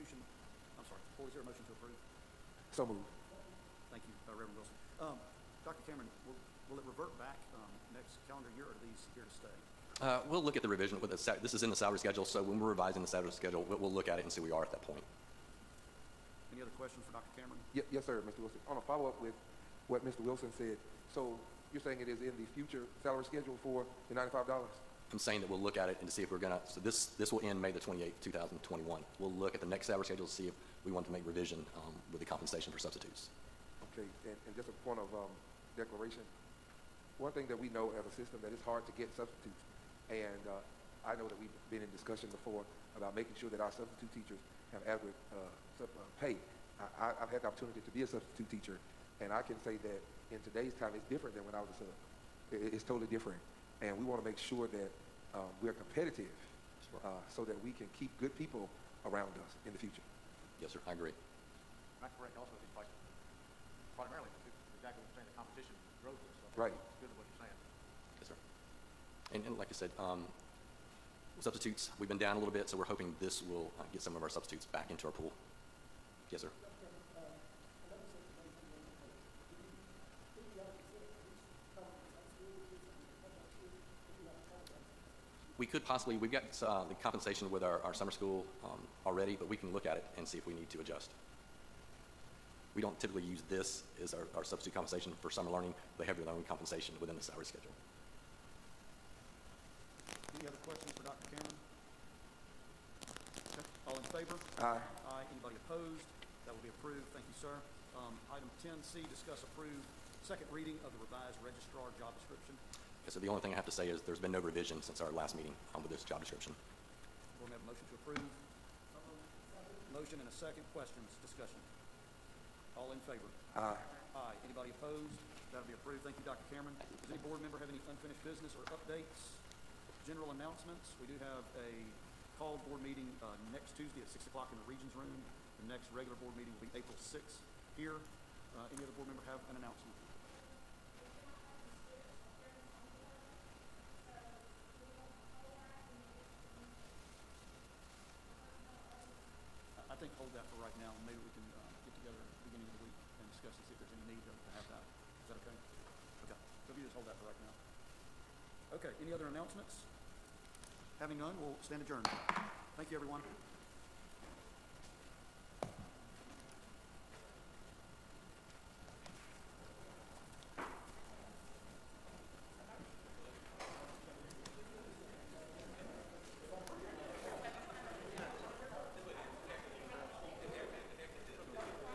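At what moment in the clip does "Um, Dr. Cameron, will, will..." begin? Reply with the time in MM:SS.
00:05.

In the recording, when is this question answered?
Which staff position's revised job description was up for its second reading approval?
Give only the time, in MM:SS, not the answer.
01:51.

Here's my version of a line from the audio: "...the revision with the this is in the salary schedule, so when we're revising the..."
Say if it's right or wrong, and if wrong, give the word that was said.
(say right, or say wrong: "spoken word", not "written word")
right.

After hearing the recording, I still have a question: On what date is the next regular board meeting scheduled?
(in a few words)
April 6th.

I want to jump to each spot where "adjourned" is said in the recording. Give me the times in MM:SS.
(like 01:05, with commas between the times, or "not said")
02:41.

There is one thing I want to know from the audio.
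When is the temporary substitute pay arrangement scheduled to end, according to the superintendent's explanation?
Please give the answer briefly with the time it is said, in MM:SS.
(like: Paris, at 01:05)
May 28, 2021, at 00:27.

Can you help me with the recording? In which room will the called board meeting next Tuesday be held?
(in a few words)
Regions Room.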